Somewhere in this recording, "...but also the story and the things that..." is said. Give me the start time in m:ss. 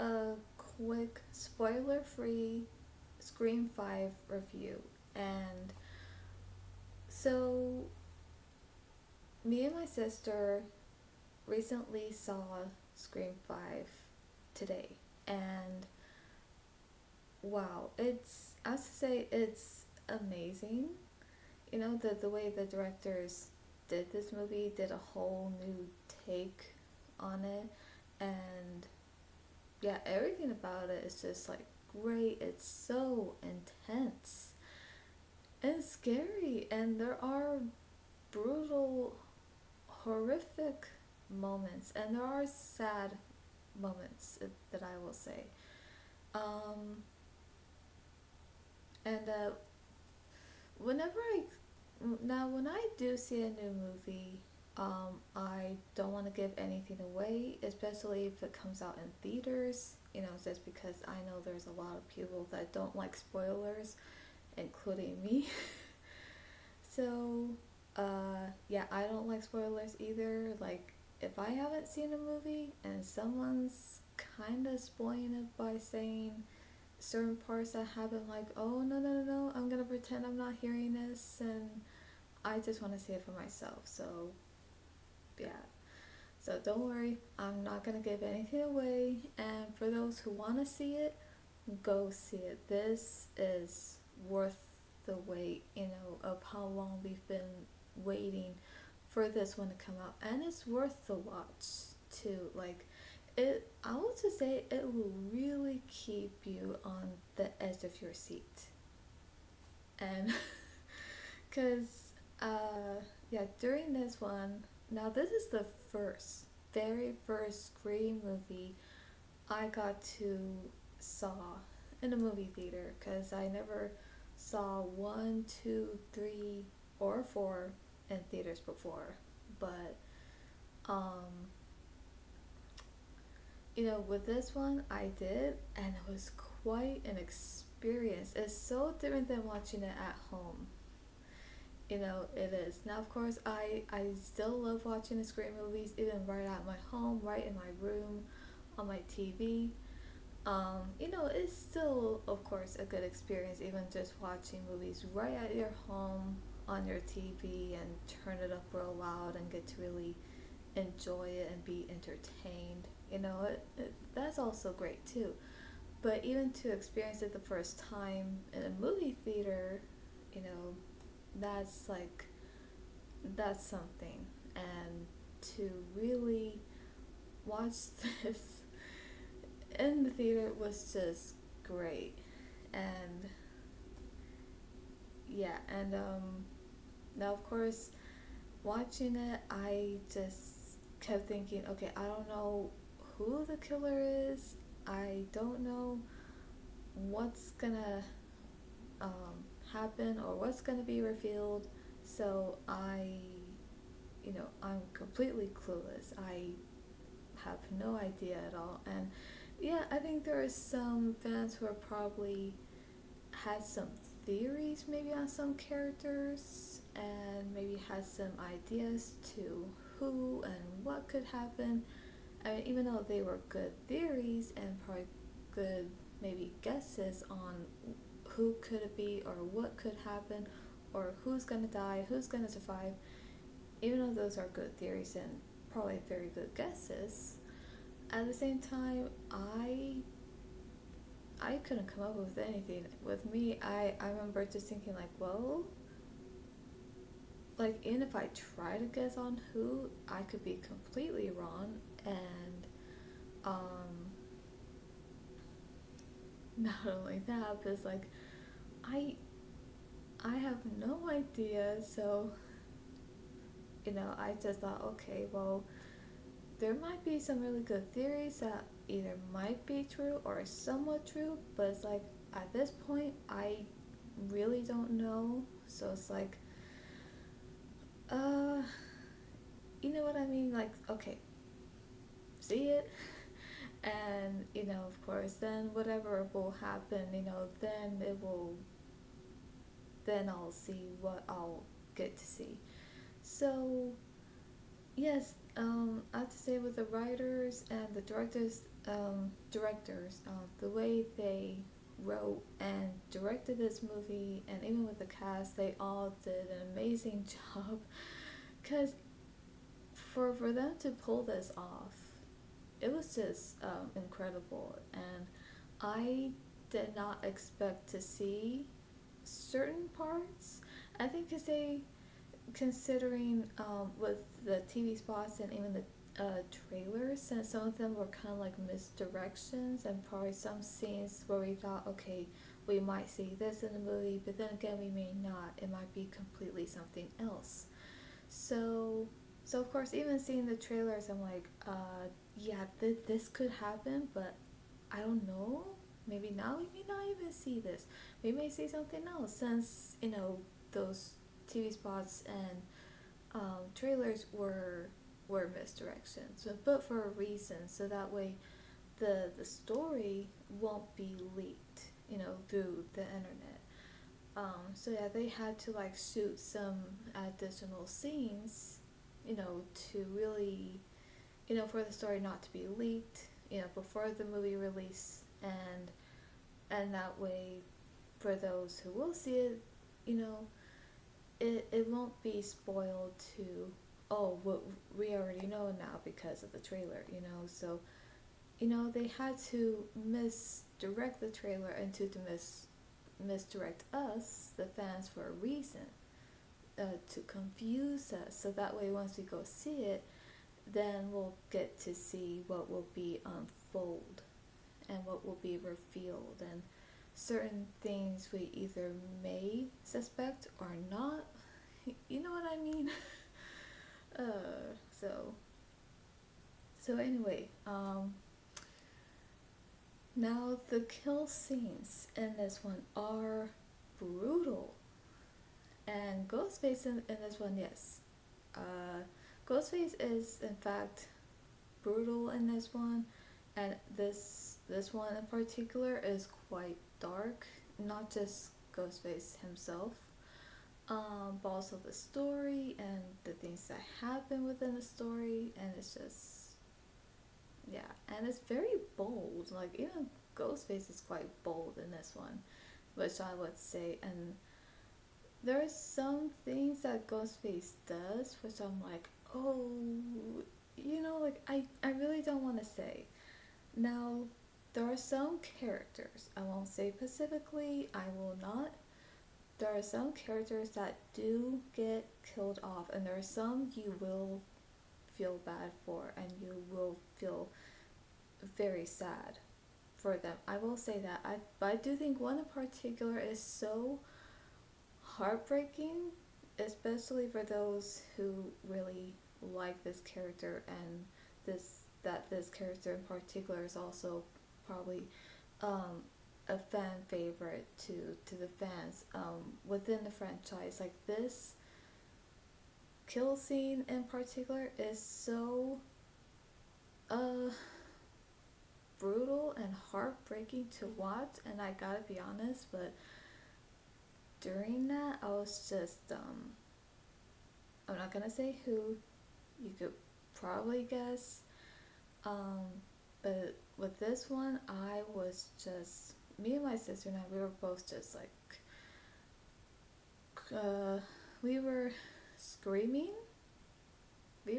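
7:21.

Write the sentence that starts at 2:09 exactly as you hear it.
But um, you know, with this one, I did, and it was quite an experience.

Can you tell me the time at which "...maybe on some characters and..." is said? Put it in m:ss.
3:34.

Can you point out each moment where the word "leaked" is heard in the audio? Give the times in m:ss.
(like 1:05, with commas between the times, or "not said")
6:01, 6:12.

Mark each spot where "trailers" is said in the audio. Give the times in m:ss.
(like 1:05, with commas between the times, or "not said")
5:26, 5:40, 5:53, 6:26, 6:31.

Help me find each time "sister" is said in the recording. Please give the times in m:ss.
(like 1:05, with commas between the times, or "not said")
0:09, 8:46.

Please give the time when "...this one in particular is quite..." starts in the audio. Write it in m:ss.
7:14.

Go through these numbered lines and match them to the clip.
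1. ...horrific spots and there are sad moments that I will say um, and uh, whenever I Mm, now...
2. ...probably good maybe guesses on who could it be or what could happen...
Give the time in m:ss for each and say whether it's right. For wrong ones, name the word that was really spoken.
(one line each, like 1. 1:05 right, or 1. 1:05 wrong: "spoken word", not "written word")
1. 0:39 wrong: "moments", not "spots"
2. 3:44 right.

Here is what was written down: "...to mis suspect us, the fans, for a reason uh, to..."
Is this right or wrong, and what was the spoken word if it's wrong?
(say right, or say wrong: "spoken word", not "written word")
wrong: "misdirect", not "suspect".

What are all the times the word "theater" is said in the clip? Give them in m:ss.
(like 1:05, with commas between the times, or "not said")
0:59, 2:02, 2:08, 2:49, 3:00.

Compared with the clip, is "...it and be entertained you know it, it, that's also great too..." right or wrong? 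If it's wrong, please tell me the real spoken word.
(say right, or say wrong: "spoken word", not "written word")
right.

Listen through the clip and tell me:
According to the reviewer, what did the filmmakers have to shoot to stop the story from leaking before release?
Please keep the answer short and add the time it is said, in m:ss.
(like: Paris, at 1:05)
Additional scenes, at 6:07.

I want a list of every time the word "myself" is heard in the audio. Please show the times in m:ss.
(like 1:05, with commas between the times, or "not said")
1:23.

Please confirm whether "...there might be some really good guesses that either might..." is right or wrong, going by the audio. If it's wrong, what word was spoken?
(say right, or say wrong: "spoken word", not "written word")
wrong: "theories", not "guesses".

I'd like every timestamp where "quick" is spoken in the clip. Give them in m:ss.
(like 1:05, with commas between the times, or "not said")
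0:00.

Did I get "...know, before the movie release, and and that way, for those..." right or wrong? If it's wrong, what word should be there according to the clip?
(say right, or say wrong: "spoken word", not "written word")
right.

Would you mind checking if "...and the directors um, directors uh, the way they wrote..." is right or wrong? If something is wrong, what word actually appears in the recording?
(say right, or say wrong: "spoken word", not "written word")
right.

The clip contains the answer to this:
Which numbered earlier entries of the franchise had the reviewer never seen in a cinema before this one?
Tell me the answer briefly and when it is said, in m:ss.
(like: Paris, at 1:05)
1, 2, 3, 4, at 2:04.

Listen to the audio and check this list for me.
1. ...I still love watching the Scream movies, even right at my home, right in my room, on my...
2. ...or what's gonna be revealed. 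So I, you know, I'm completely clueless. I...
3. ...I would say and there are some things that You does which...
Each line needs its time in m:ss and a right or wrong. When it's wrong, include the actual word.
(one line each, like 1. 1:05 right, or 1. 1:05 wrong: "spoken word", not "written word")
1. 2:23 right
2. 3:20 right
3. 7:33 wrong: "Ghostface", not "You".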